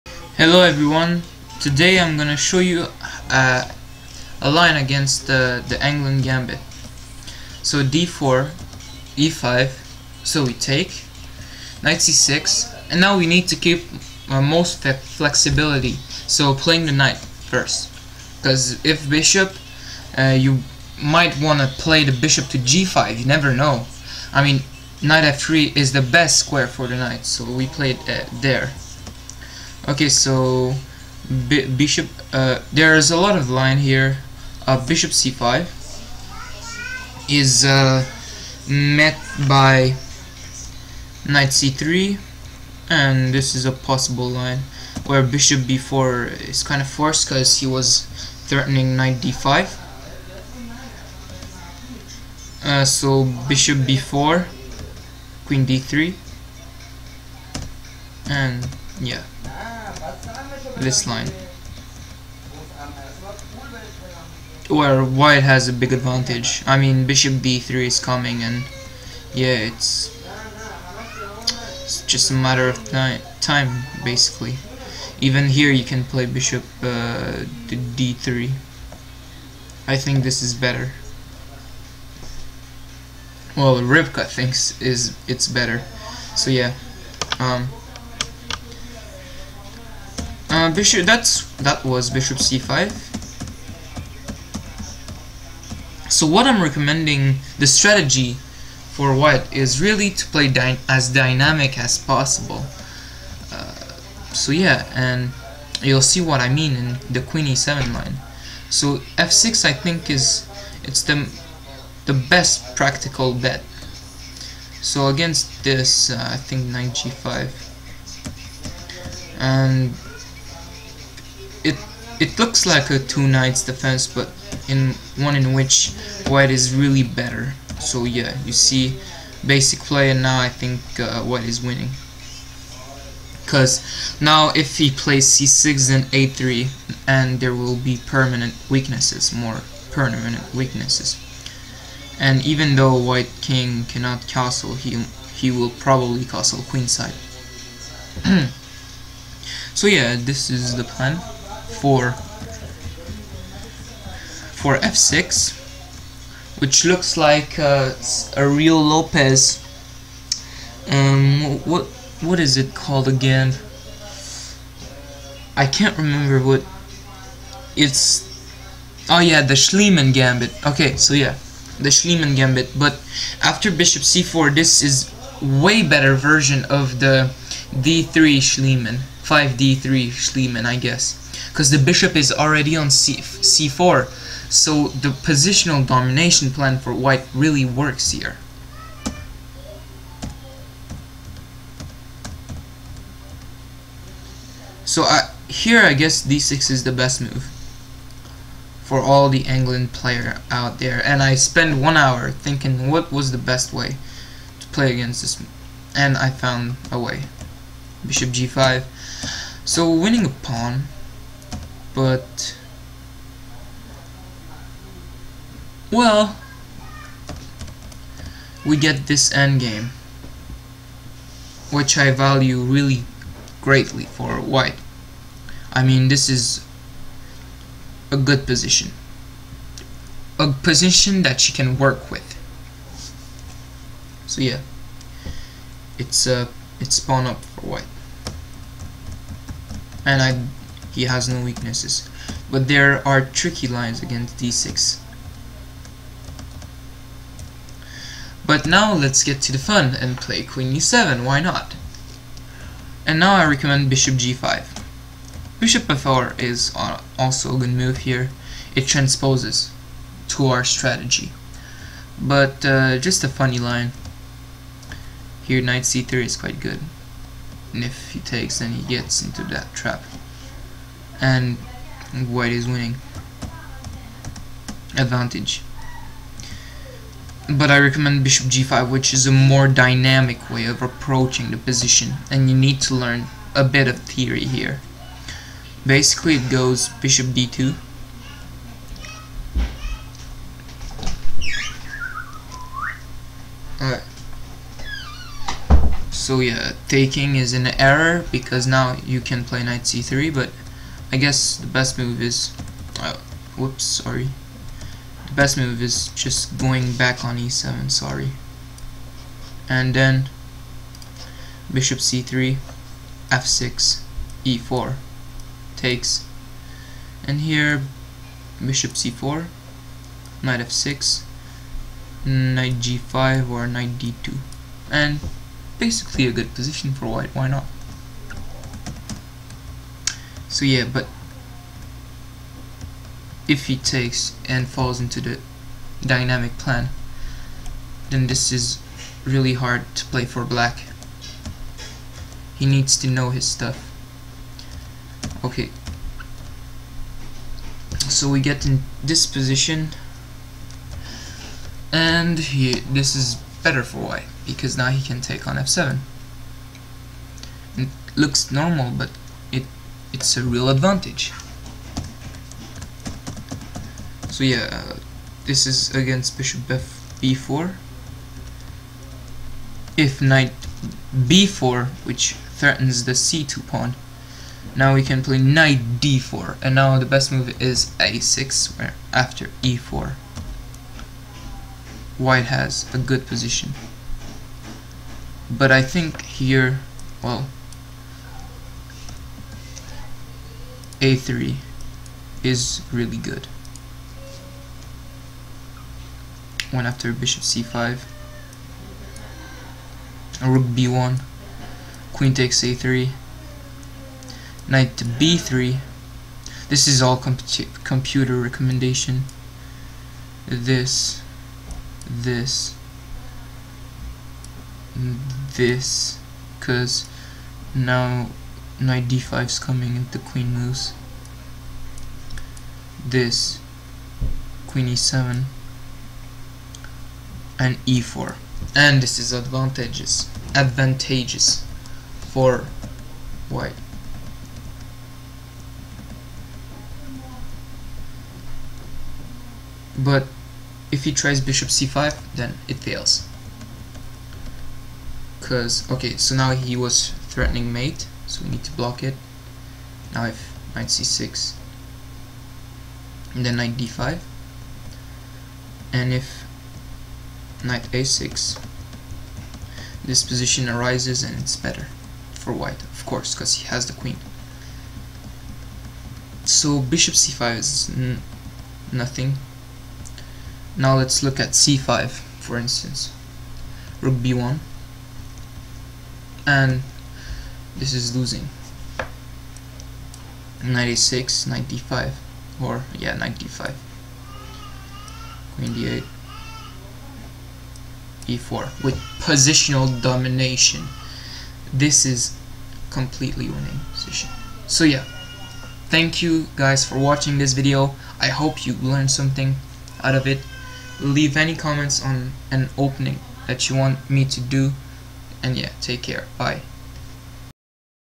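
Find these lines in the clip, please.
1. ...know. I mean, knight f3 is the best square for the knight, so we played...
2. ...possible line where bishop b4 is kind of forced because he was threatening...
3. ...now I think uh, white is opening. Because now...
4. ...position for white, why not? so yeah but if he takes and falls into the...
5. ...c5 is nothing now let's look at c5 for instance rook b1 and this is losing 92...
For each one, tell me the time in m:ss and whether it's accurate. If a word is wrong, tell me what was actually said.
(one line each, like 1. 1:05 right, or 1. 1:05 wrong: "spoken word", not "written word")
1. 0:23 right
2. 0:43 right
3. 2:10 wrong: "winning", not "opening"
4. 5:26 right
5. 7:47 wrong: "96", not "92".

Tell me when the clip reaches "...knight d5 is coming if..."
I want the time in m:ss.
6:58.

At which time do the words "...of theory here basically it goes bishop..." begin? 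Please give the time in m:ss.
4:43.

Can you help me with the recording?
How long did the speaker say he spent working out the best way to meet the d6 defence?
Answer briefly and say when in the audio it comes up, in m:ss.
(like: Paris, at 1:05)
1 hour, at 3:21.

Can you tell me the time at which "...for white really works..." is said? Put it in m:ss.
3:06.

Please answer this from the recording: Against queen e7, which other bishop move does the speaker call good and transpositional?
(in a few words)
Bishop f4.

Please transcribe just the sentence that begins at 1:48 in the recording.
So f6 I think is it's the the best practical bet.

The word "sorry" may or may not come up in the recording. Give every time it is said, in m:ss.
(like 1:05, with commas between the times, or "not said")
5:03, 5:07.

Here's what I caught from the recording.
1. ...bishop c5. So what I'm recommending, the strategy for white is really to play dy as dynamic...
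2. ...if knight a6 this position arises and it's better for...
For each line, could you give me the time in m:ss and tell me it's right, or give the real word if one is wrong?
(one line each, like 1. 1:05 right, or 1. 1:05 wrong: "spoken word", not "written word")
1. 1:32 right
2. 7:36 right.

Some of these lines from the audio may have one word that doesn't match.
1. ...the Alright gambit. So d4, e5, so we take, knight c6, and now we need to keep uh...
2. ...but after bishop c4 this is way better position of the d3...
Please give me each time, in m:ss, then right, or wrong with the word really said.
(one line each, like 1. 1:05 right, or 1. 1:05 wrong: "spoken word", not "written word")
1. 0:05 wrong: "Englund", not "Alright"
2. 2:52 wrong: "version", not "position".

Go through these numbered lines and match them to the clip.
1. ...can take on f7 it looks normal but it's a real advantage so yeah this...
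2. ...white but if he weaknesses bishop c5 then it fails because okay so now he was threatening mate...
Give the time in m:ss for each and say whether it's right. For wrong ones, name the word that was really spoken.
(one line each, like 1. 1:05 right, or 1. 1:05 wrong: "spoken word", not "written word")
1. 5:55 right
2. 7:13 wrong: "tries", not "weaknesses".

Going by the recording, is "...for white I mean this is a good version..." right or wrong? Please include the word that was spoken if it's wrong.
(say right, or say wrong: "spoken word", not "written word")
wrong: "position", not "version".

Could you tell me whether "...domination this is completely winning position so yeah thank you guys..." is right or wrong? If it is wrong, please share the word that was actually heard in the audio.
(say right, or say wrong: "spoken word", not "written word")
right.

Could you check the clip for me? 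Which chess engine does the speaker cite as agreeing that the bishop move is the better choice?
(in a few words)
Rybka.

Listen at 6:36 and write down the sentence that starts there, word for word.
One after bishop c5, rook b1, queen takes a3, knight to b3.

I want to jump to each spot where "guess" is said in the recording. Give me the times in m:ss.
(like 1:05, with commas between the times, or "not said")
3:00, 3:15, 5:01.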